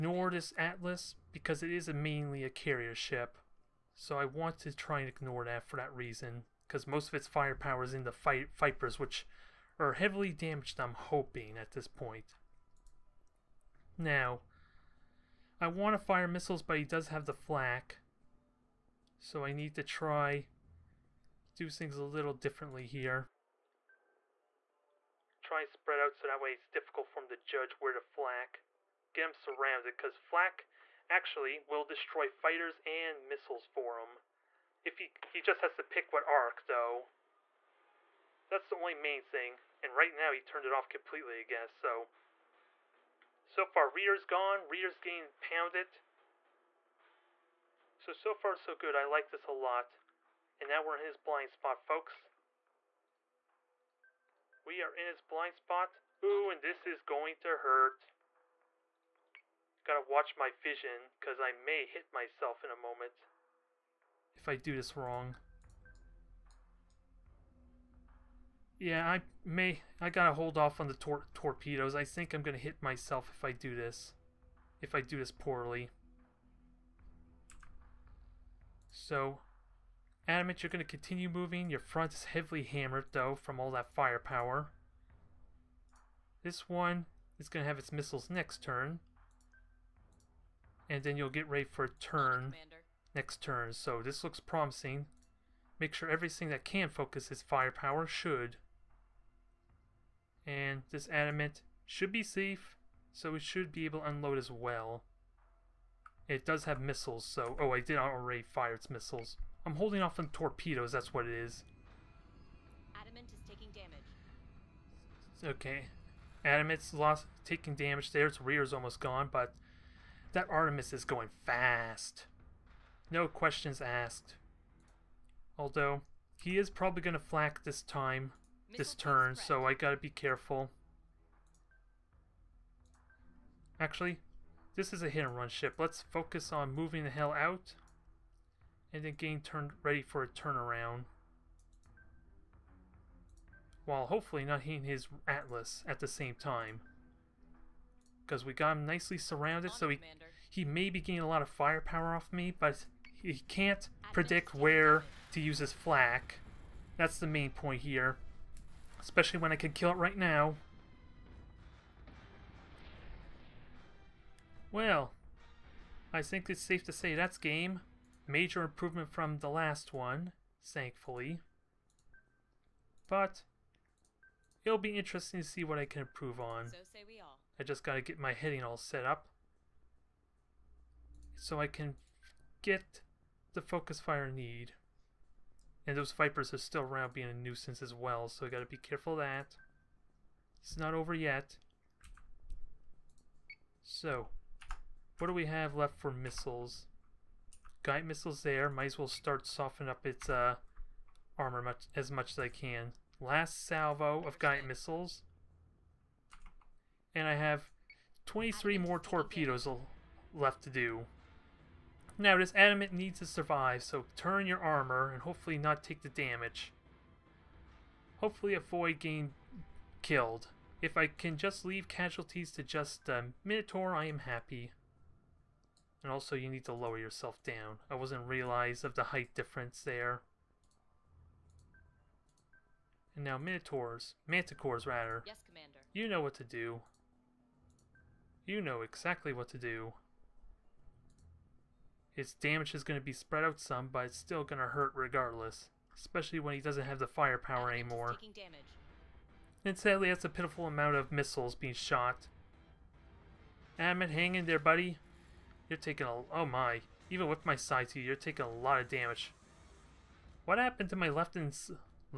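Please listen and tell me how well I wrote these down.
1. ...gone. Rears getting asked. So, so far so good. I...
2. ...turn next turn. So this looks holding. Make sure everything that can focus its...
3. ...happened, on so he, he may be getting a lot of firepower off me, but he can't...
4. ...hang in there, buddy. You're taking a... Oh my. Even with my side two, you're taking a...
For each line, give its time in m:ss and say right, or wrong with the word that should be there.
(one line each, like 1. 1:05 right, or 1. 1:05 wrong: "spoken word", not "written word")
1. 0:44 wrong: "pounded", not "asked"
2. 1:31 wrong: "promising", not "holding"
3. 2:29 wrong: "surrounded", not "happened"
4. 4:14 right.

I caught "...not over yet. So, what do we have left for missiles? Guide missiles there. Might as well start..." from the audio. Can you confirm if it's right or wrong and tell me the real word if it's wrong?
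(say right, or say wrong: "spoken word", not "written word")
right.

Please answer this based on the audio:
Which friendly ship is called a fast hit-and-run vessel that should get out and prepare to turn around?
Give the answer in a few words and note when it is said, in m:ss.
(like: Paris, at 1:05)
Artemis, at 2:00.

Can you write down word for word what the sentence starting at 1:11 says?
I think I'm gonna hit myself if I do this.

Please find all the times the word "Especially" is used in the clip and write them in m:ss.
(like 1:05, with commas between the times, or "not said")
2:39, 4:05.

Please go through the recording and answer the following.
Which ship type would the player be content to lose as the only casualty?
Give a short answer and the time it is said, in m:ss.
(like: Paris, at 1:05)
Minotaur, at 3:43.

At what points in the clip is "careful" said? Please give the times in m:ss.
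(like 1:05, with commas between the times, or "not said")
2:10, 3:08.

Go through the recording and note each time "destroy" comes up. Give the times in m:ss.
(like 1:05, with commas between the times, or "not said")
0:31.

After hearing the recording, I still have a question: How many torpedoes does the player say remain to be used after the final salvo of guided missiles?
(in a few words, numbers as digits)
23.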